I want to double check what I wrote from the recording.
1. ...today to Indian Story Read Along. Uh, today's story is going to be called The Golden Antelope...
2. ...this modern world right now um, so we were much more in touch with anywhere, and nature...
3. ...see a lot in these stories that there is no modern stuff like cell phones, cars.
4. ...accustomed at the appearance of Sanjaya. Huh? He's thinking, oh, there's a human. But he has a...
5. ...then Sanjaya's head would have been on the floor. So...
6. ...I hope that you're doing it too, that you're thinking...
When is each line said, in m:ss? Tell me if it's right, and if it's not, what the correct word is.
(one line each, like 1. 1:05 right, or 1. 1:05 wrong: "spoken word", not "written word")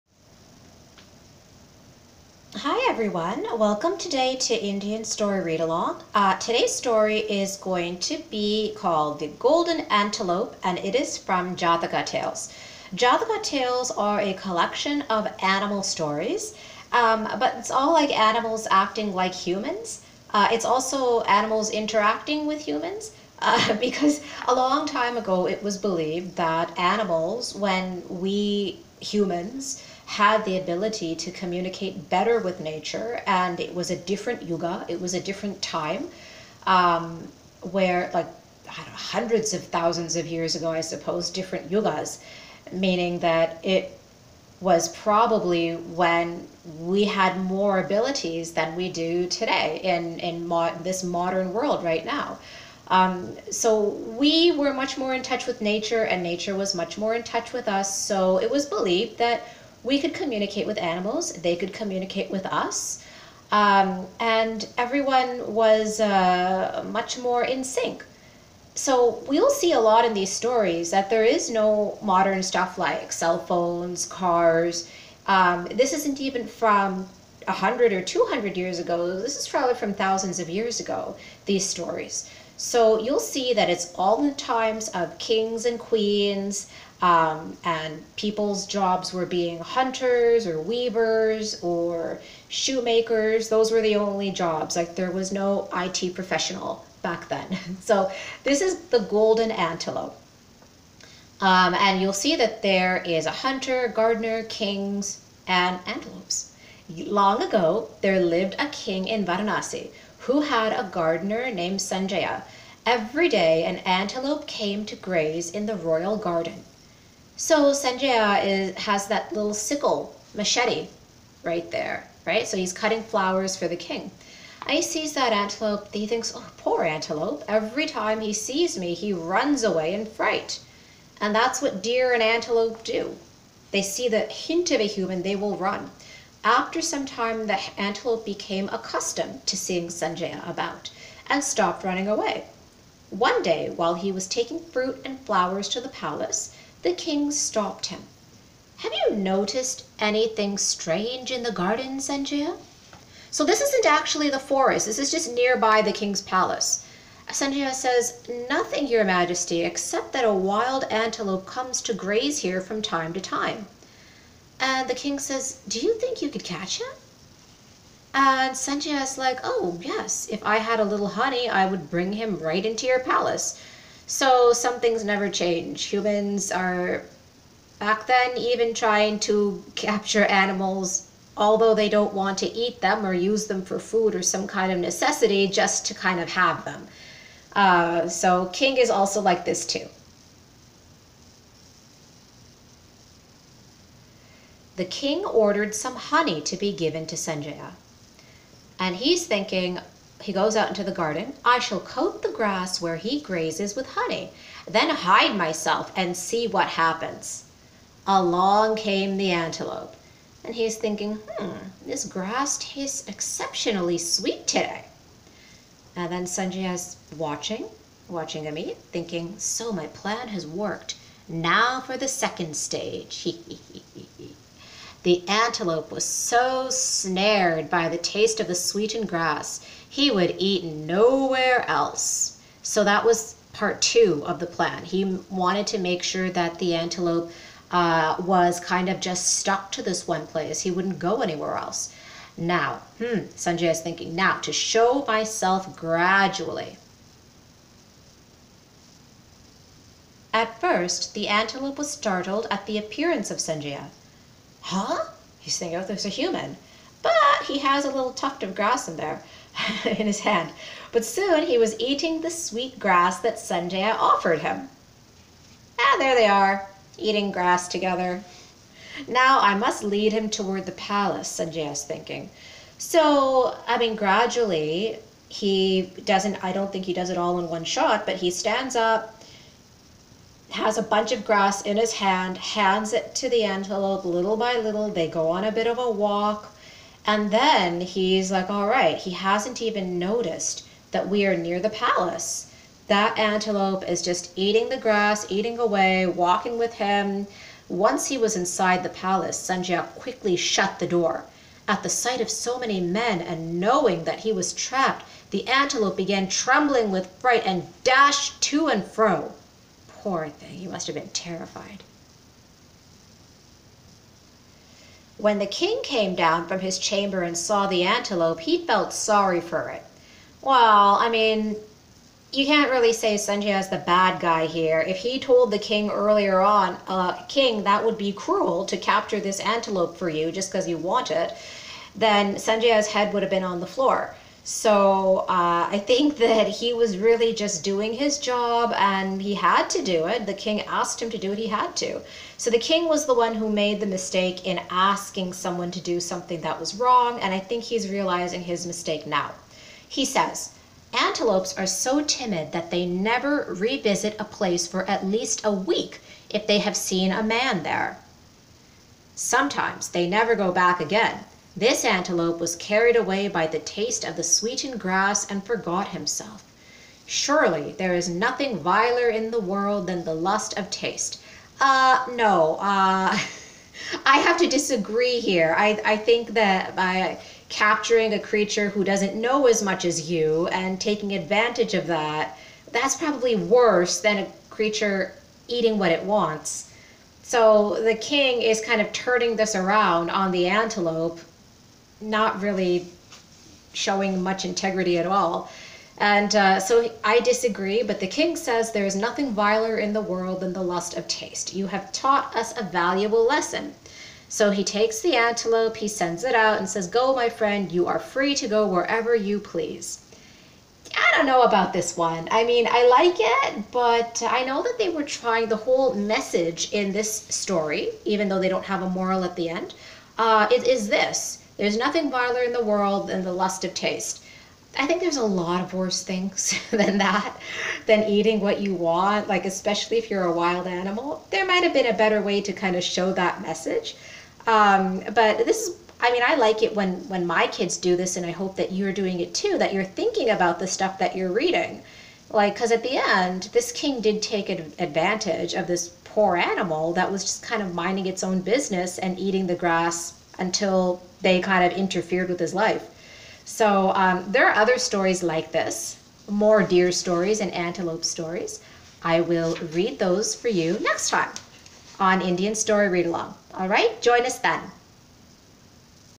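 1. 0:03 right
2. 0:50 wrong: "nature", not "anywhere"
3. 1:09 right
4. 4:11 wrong: "startled", not "accustomed"
5. 5:31 right
6. 7:18 right.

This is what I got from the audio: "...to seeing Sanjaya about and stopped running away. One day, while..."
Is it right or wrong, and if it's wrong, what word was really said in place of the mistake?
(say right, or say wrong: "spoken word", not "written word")
right.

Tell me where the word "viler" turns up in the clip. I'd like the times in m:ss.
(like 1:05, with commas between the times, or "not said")
6:08, 6:39, 7:02.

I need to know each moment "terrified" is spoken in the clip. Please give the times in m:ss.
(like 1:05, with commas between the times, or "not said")
5:11.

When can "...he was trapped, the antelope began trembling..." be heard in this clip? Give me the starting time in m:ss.
5:04.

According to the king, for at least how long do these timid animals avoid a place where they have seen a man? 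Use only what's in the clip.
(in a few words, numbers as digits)
A week.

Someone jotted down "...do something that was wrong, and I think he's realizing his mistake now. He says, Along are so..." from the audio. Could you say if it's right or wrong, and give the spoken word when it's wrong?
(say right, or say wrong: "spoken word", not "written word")
wrong: "Antelopes", not "Along".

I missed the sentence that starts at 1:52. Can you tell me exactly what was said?
Every day an antelope came to graze in the royal garden.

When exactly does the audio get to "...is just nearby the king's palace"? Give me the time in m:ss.
2:34.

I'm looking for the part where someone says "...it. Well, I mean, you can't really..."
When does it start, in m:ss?
5:19.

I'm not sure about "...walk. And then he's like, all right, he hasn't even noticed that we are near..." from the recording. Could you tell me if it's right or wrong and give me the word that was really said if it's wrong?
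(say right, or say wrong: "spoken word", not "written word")
right.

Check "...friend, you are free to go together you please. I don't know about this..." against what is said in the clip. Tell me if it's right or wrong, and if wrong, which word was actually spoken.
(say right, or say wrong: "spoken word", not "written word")
wrong: "wherever", not "together".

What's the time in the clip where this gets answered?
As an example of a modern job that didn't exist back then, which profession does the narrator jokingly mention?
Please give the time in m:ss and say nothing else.
1:35.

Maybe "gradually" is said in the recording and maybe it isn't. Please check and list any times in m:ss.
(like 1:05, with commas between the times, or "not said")
4:05, 4:33.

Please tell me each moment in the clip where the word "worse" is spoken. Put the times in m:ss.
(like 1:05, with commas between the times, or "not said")
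6:23, 7:05.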